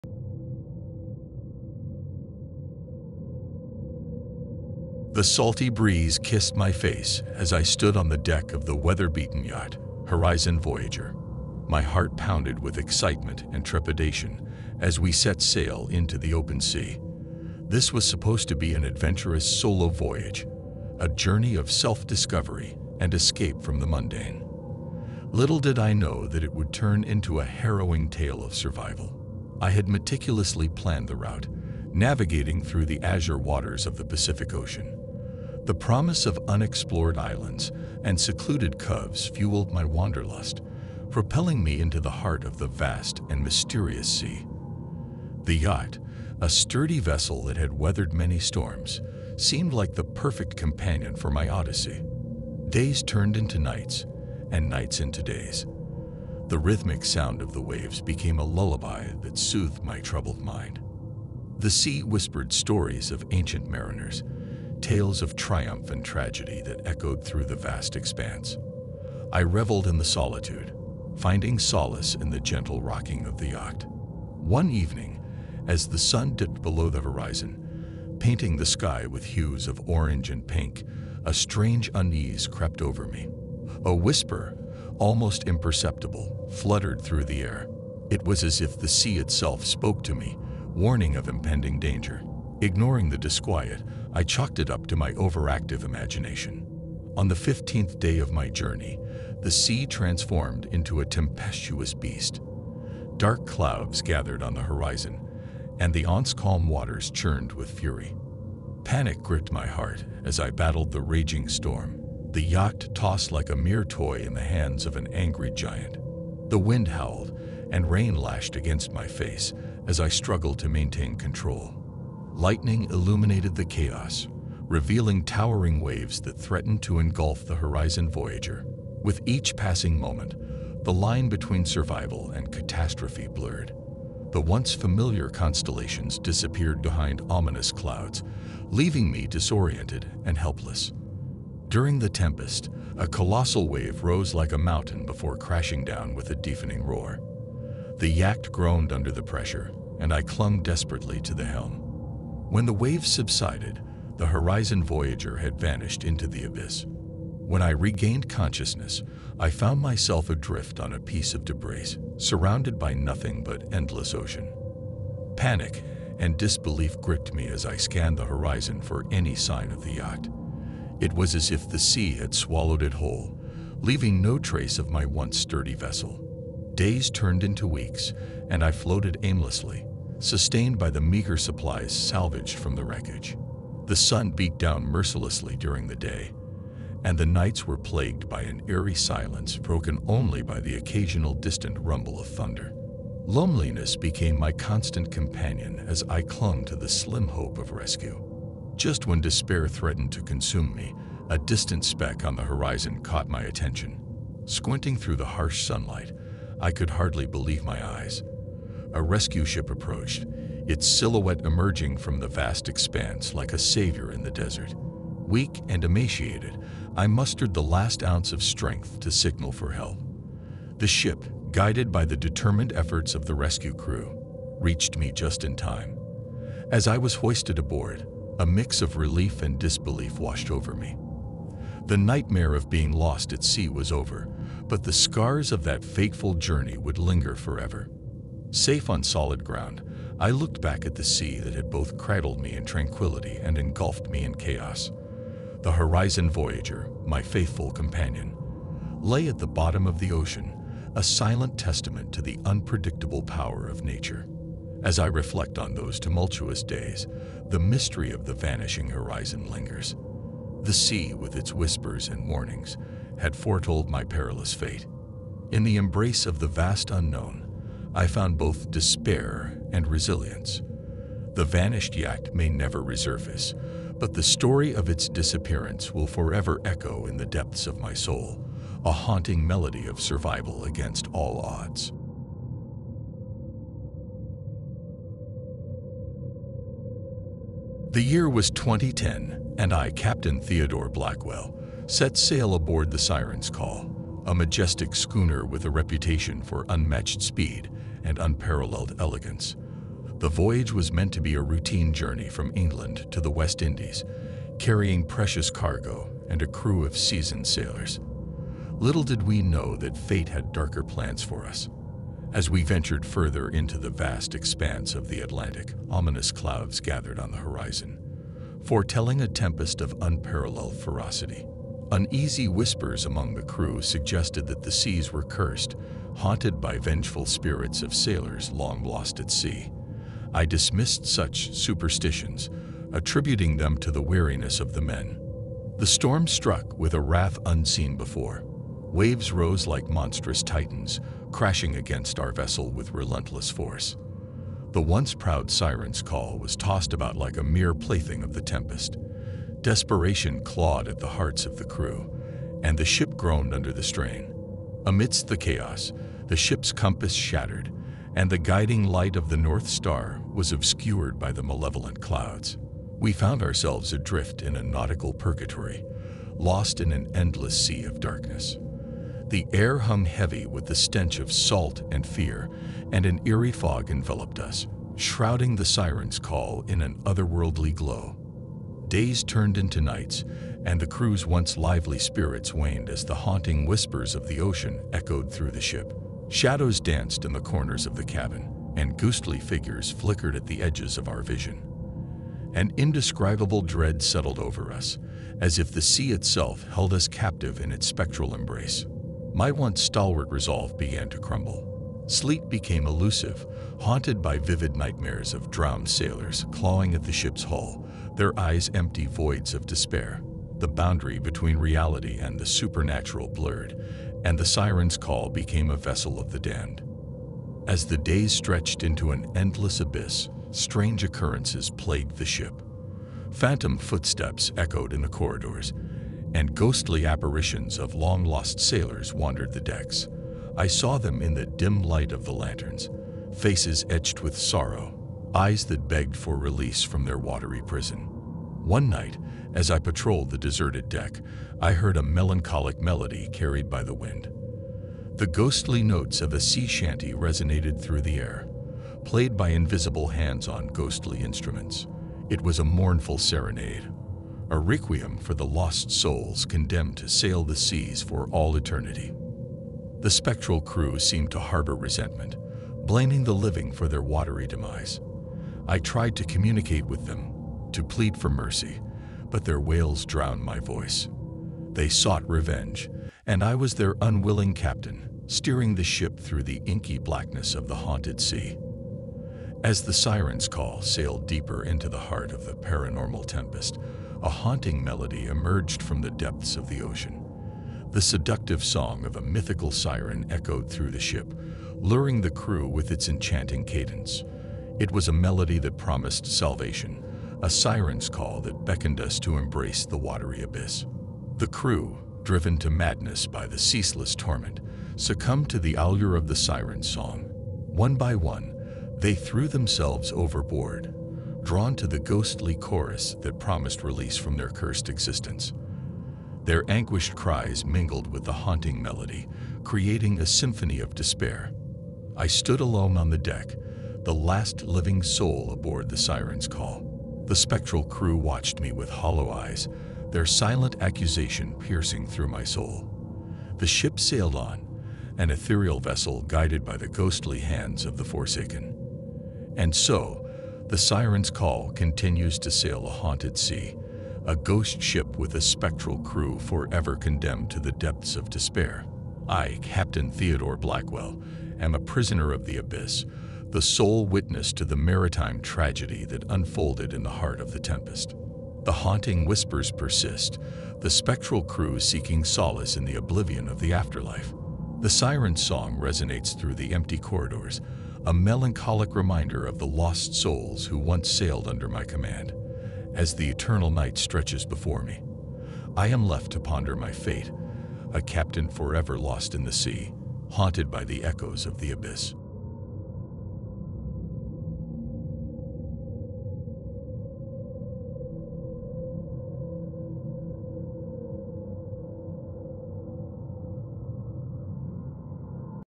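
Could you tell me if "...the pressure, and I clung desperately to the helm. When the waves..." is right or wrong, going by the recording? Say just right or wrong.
right.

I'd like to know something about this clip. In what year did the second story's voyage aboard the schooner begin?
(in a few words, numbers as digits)
2010.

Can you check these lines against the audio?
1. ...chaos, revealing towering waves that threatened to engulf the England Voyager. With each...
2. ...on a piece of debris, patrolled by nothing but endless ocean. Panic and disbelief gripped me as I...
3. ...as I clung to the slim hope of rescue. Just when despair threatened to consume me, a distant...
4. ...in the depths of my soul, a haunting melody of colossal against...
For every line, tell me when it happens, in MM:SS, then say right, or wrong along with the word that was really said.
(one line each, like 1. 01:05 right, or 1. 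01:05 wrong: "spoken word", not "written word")
1. 02:03 wrong: "Horizon", not "England"
2. 02:40 wrong: "surrounded", not "patrolled"
3. 03:15 right
4. 04:37 wrong: "survival", not "colossal".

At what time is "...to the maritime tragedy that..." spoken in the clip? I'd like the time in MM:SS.
09:14.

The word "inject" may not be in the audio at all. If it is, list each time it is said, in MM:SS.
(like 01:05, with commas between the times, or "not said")
not said.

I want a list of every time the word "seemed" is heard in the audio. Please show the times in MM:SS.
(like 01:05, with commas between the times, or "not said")
00:49, 07:40.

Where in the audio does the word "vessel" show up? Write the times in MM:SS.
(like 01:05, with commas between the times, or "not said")
00:46, 02:55, 05:42, 06:55, 08:55.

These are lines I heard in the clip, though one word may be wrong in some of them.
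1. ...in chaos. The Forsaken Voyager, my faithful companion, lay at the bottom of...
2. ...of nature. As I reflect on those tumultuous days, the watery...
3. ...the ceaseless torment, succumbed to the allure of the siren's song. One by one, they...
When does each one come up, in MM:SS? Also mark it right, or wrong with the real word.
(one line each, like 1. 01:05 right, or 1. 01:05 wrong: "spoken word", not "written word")
1. 04:04 wrong: "Horizon", not "Forsaken"
2. 04:13 wrong: "mystery", not "watery"
3. 08:23 right.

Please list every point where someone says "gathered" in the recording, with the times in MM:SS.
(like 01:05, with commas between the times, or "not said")
01:44, 05:16.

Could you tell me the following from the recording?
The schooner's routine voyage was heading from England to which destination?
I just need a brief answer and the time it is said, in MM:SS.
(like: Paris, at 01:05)
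West Indies, at 05:03.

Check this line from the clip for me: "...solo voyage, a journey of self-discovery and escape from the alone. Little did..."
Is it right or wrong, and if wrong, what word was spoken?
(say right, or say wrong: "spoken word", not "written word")
wrong: "mundane", not "alone".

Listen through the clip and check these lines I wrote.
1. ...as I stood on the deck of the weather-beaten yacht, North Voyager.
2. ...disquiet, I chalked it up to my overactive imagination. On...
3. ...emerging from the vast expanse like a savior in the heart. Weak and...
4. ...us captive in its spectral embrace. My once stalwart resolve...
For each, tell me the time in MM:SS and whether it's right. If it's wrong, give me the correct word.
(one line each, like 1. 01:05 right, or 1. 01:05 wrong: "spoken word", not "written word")
1. 00:07 wrong: "Horizon", not "North"
2. 01:33 right
3. 03:31 wrong: "desert", not "heart"
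4. 06:36 right.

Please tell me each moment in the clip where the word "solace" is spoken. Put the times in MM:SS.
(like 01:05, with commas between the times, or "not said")
01:11, 09:22.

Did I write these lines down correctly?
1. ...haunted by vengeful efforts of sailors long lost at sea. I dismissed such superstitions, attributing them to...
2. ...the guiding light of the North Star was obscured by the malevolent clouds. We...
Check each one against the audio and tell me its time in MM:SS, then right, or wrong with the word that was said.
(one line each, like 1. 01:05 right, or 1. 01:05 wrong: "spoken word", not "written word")
1. 05:26 wrong: "spirits", not "efforts"
2. 05:58 right.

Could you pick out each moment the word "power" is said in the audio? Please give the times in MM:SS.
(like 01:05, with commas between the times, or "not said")
04:13.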